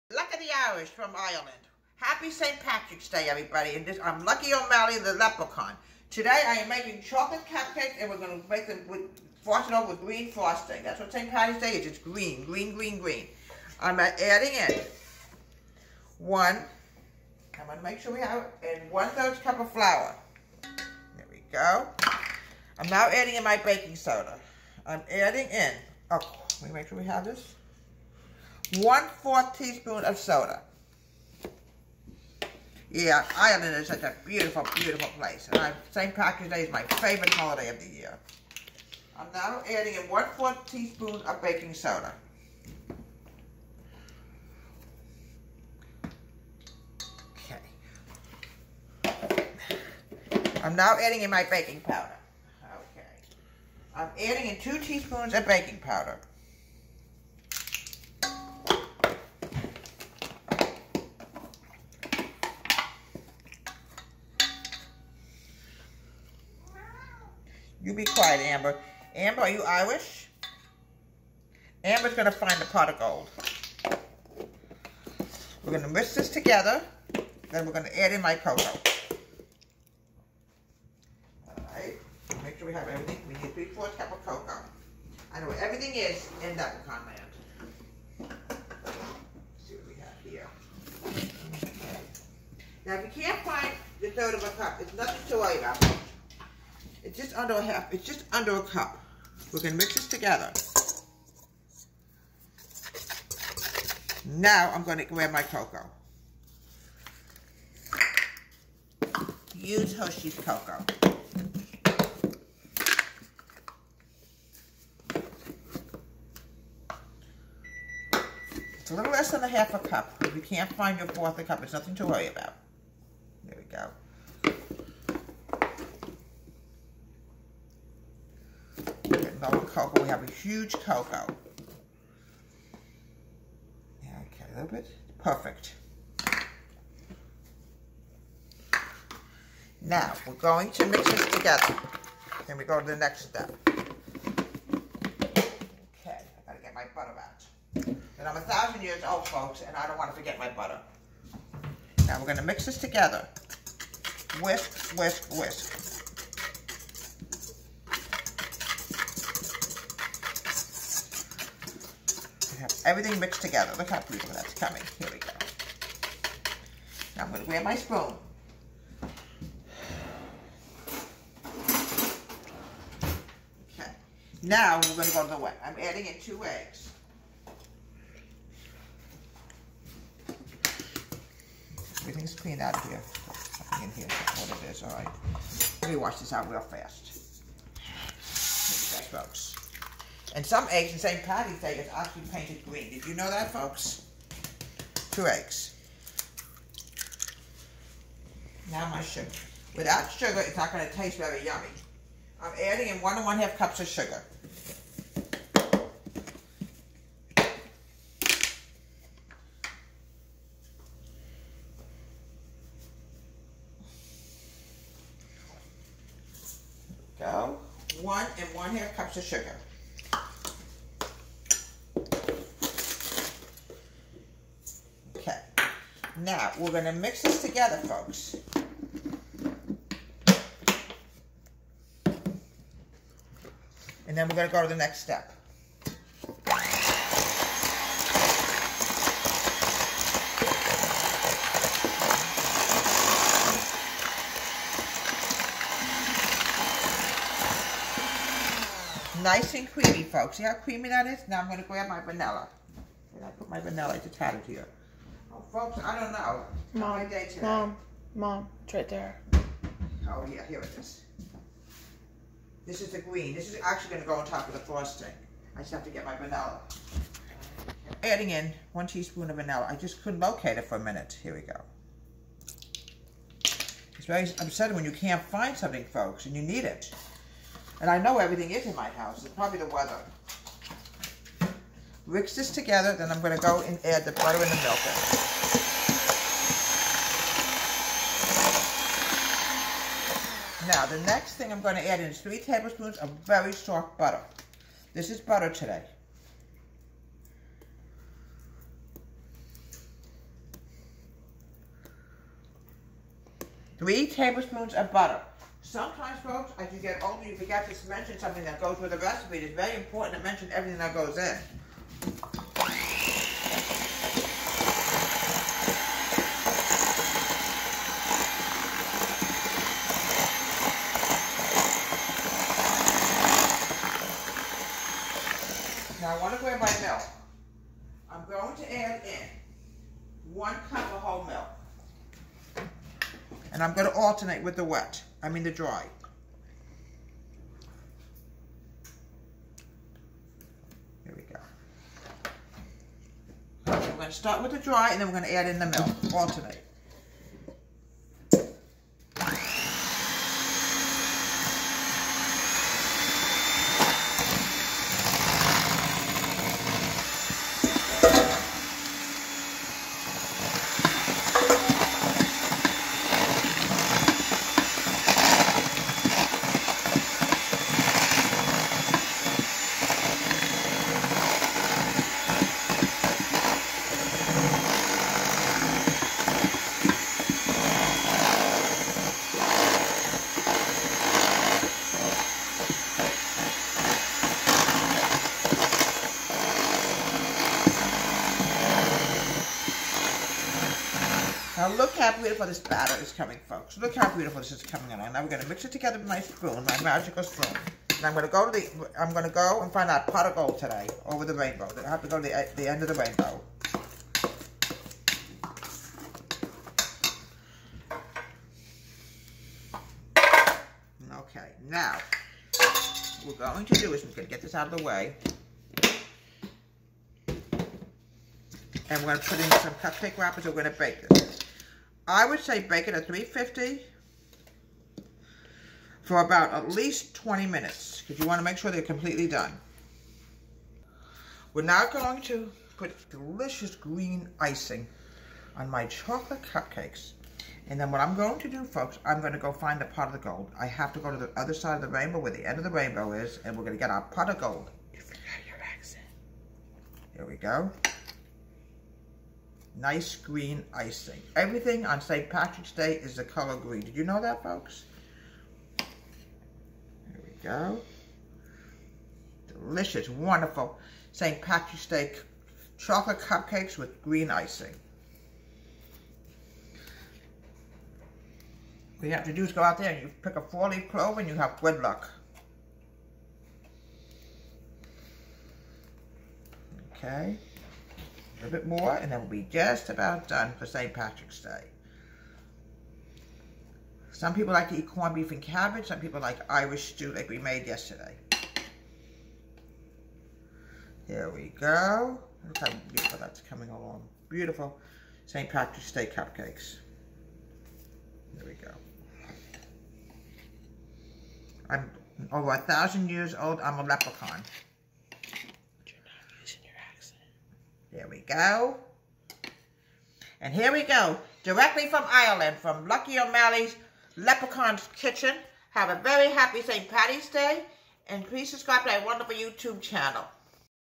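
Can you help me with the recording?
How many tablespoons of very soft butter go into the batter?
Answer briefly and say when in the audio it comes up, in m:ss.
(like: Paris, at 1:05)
3 tablespoons, at 4:52.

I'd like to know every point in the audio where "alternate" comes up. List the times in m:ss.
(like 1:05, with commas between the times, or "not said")
5:33, 5:46.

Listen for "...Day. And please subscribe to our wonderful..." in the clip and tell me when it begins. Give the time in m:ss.
8:37.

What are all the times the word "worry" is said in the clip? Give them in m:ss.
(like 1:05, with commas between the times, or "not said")
1:35, 2:02.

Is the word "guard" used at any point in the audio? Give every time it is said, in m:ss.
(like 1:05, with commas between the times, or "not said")
not said.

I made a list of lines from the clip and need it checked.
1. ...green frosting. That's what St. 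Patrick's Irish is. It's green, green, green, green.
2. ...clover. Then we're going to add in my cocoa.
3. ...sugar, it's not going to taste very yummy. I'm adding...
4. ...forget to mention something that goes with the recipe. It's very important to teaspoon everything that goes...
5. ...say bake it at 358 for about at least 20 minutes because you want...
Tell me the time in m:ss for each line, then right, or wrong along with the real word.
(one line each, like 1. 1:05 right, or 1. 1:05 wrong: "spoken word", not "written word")
1. 0:10 wrong: "Day", not "Irish"
2. 1:16 wrong: "together", not "clover"
3. 3:20 right
4. 5:07 wrong: "mention", not "teaspoon"
5. 7:02 wrong: "350", not "358".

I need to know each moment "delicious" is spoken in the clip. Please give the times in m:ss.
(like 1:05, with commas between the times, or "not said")
7:13, 7:39.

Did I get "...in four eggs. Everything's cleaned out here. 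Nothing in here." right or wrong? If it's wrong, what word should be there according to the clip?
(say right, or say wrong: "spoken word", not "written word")
wrong: "two", not "four".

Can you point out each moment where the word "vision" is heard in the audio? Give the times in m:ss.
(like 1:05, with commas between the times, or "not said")
not said.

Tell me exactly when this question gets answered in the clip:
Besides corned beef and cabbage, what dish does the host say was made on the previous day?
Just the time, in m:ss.
8:06.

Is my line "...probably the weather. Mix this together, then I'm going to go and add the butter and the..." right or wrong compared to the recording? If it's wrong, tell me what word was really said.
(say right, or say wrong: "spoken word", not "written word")
right.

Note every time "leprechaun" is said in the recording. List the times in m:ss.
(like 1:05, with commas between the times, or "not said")
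0:05, 8:23, 8:34.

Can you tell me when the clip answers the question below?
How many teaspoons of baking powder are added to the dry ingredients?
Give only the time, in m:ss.
0:54.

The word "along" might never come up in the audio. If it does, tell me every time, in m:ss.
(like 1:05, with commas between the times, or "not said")
6:34, 8:13.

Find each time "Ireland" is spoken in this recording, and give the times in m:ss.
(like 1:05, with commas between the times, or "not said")
0:01, 0:33, 8:32.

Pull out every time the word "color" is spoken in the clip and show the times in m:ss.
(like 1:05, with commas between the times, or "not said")
7:33.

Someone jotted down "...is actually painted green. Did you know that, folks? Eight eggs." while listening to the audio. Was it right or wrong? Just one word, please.
wrong.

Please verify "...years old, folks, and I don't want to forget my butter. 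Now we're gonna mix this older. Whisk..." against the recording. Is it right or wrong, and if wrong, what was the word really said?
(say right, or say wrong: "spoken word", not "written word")
wrong: "together", not "older".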